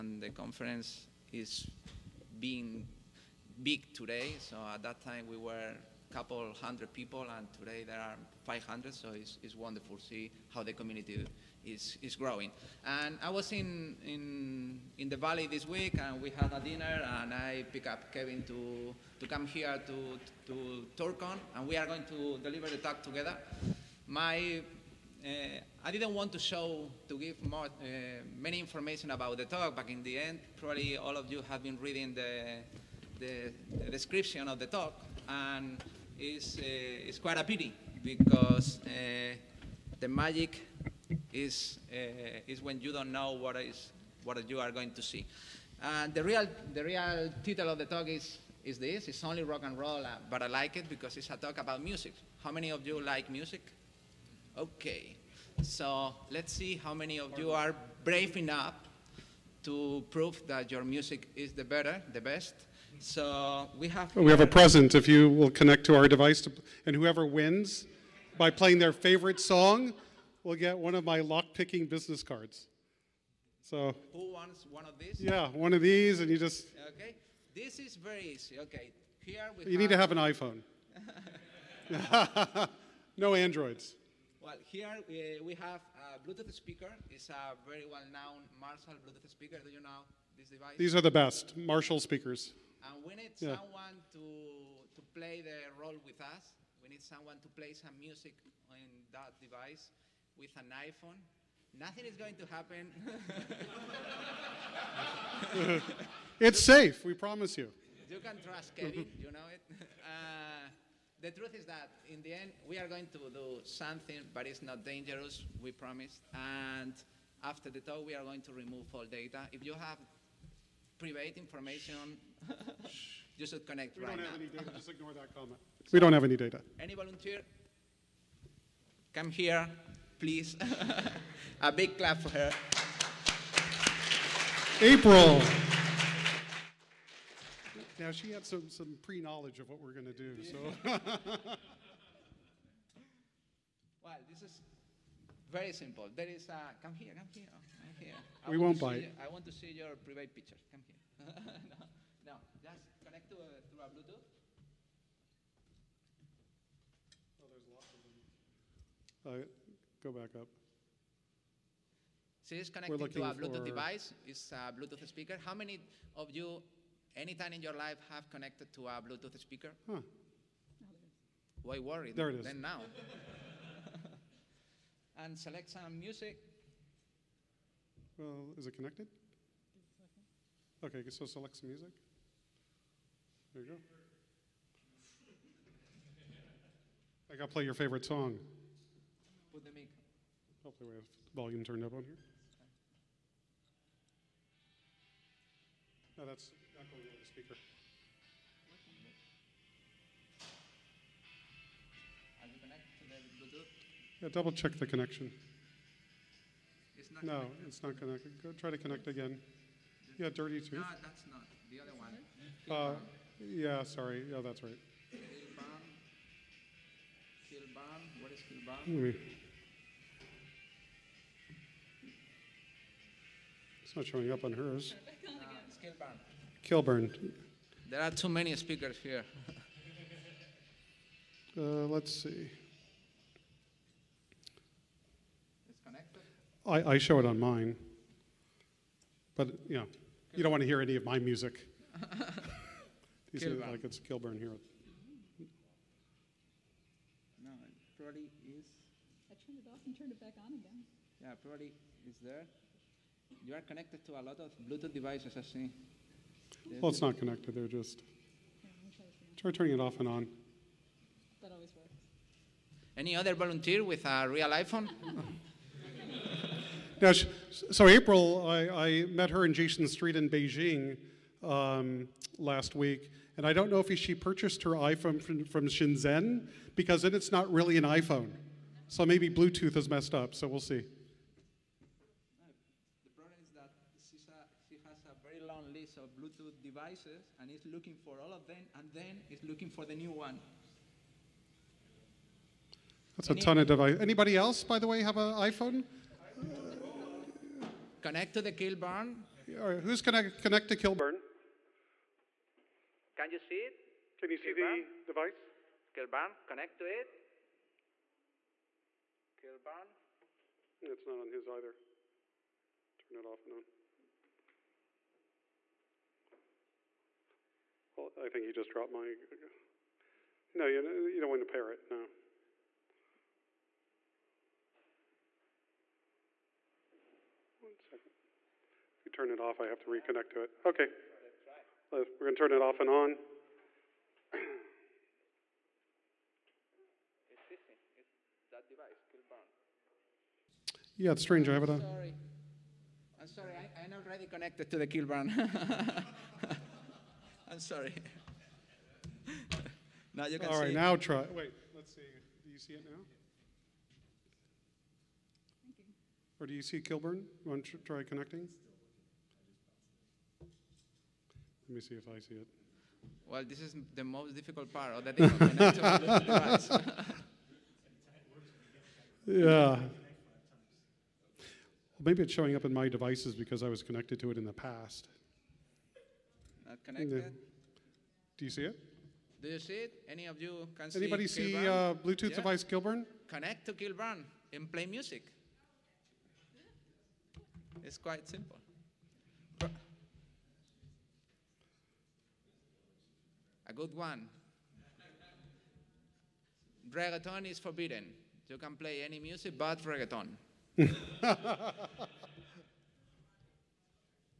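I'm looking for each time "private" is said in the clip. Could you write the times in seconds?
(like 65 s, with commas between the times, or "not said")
120 s, 150 s.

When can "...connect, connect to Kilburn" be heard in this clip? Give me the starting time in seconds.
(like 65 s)
300 s.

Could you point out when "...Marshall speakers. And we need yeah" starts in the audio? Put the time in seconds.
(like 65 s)
91 s.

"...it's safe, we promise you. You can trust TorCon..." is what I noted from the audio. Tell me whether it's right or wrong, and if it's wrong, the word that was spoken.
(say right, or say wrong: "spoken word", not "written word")
wrong: "Kevin", not "TorCon".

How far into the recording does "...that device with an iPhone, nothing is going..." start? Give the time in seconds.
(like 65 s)
99 s.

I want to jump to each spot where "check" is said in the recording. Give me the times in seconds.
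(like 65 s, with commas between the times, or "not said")
204 s.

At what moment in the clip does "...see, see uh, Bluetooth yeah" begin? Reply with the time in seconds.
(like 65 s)
381 s.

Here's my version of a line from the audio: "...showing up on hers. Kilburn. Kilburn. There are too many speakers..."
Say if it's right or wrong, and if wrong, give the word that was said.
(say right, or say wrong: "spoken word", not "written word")
right.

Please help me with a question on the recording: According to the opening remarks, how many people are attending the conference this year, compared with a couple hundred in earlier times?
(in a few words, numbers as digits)
500.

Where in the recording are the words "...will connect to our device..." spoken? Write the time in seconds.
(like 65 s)
65 s.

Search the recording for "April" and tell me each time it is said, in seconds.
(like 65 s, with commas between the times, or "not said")
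134 s, 267 s.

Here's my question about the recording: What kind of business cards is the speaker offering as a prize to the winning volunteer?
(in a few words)
Lockpicking business cards.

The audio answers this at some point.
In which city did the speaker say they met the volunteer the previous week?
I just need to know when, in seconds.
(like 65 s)
270 s.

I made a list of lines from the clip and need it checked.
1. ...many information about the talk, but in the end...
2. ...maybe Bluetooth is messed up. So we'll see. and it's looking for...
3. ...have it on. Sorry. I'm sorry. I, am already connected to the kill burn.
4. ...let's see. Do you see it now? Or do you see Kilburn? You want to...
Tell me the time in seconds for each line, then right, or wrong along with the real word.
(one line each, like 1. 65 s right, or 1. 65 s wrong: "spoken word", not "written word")
1. 28 s right
2. 279 s right
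3. 341 s right
4. 351 s right.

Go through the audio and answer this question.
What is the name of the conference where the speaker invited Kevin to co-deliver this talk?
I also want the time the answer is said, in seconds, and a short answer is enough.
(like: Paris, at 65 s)
TorCon, at 20 s.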